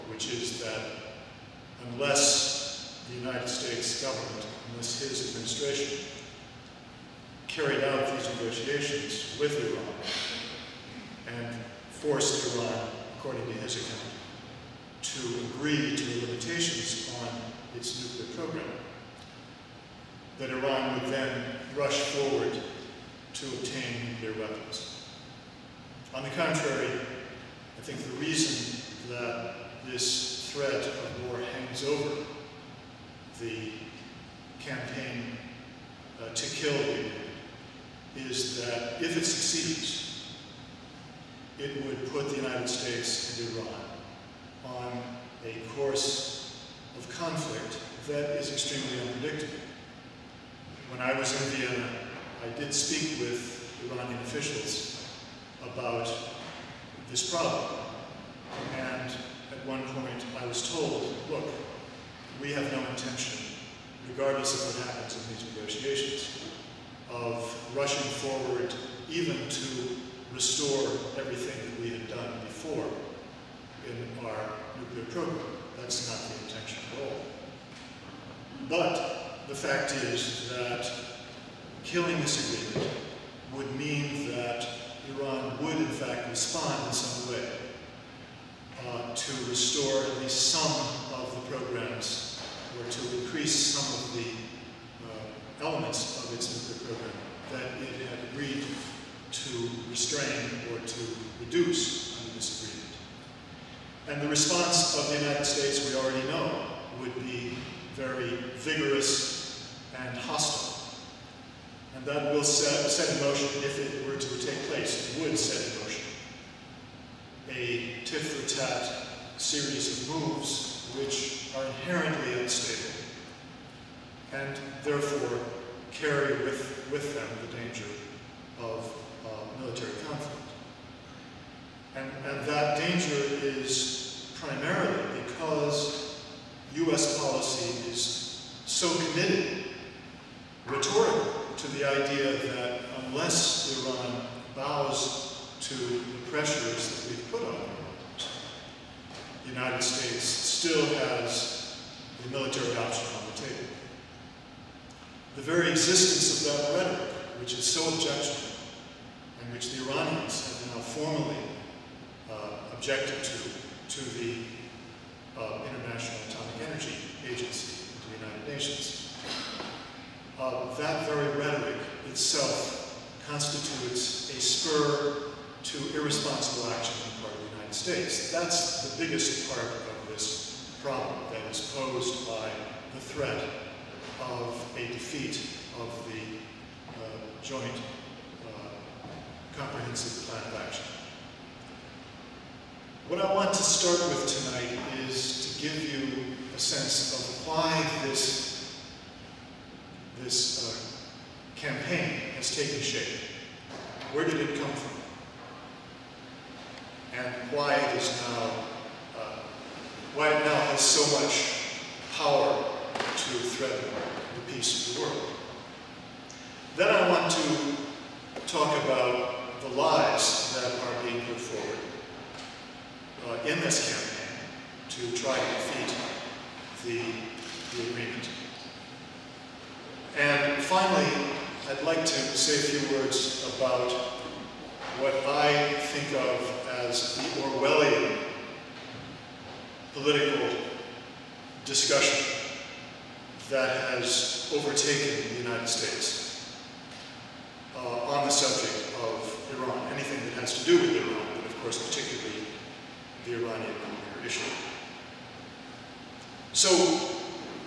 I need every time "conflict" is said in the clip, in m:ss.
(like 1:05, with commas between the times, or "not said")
0:47, 2:10.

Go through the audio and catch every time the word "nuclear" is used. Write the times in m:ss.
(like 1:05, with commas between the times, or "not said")
0:18, 0:24, 1:14, 1:36, 4:13.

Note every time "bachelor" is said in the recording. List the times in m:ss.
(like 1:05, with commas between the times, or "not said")
not said.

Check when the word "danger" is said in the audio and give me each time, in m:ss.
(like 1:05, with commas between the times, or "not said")
2:07, 2:12.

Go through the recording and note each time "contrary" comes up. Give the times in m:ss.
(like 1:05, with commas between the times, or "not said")
0:26.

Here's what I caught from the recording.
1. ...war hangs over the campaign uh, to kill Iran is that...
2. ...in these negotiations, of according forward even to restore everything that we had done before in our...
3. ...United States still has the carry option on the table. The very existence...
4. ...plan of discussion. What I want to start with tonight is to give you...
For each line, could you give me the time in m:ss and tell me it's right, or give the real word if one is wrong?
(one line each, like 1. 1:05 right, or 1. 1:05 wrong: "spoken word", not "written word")
1. 0:31 right
2. 1:05 wrong: "rushing", not "according"
3. 2:29 wrong: "military", not "carry"
4. 3:10 wrong: "action", not "discussion".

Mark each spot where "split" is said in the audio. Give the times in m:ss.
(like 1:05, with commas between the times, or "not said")
not said.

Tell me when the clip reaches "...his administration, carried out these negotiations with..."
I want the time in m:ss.
0:04.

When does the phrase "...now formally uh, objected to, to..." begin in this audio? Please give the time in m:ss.
2:40.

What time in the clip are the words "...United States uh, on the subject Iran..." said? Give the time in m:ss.
4:05.